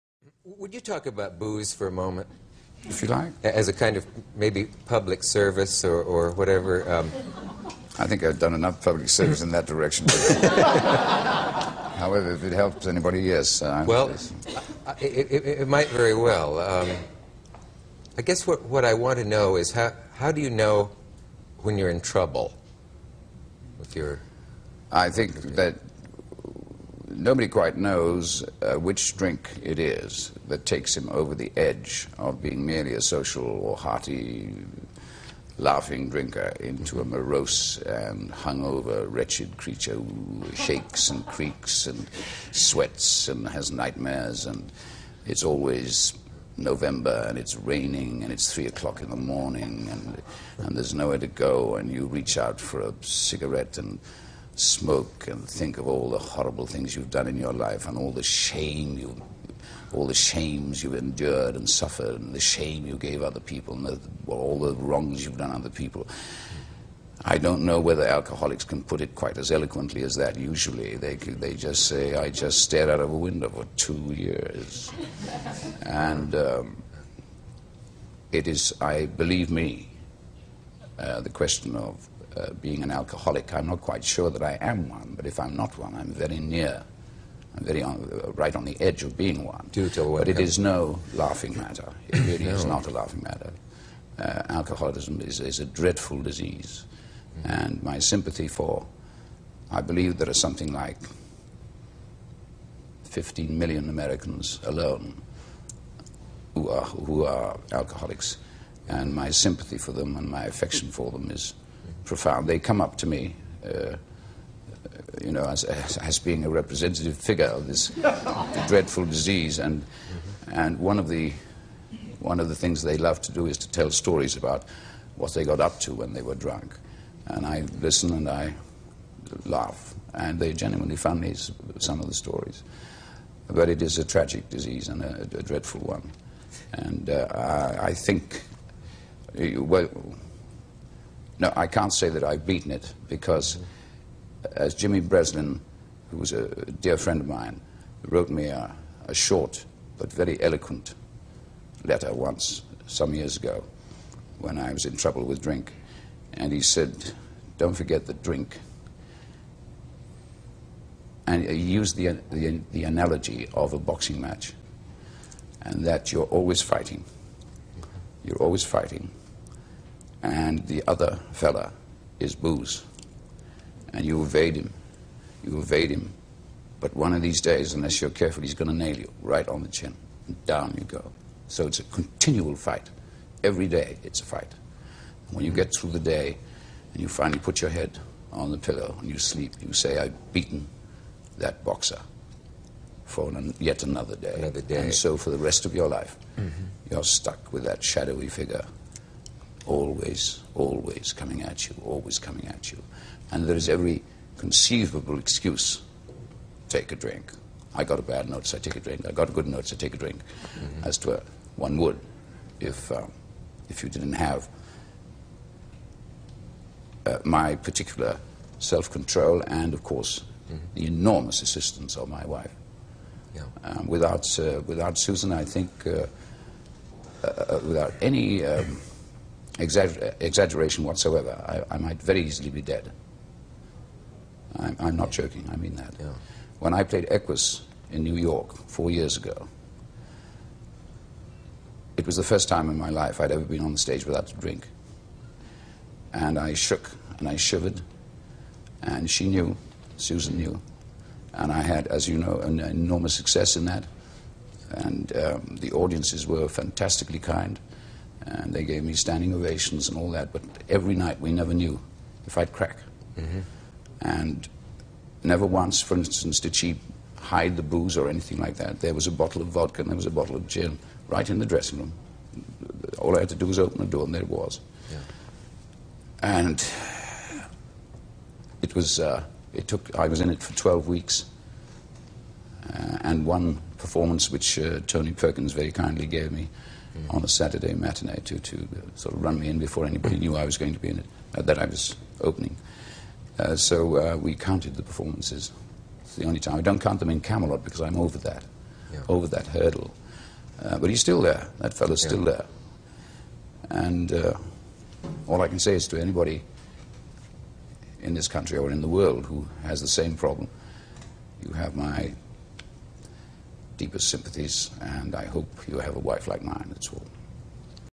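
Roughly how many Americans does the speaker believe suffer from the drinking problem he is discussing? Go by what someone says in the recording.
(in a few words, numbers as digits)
15 million.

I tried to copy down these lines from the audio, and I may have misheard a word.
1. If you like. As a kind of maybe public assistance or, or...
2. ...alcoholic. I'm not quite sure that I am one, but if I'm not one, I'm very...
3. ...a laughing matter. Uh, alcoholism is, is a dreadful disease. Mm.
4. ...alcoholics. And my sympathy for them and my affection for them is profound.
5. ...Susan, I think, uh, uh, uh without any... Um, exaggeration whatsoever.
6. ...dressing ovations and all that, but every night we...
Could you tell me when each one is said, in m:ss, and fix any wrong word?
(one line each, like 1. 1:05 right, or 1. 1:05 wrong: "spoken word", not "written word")
1. 0:02 wrong: "service", not "assistance"
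2. 1:22 right
3. 1:32 right
4. 1:47 right
5. 3:44 right
6. 4:18 wrong: "standing", not "dressing".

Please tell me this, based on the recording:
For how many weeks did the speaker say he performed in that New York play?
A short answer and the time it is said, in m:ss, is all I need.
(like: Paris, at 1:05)
12, at 4:40.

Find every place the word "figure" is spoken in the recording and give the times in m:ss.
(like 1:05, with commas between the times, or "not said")
1:57, 3:18.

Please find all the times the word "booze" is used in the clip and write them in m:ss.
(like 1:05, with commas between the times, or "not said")
0:01, 2:52, 4:27.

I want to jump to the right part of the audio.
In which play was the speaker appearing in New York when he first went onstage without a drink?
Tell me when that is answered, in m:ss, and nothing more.
3:57.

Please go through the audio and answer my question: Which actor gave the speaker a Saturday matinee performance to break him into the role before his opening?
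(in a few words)
Tony Perkins.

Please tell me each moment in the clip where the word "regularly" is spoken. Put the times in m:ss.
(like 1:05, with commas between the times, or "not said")
not said.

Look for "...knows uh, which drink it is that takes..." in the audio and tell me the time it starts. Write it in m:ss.
0:27.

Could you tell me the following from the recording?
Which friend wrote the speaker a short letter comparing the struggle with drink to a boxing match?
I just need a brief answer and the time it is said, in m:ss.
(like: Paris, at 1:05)
Jimmy Breslin, at 2:24.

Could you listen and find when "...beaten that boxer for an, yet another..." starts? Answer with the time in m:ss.
3:10.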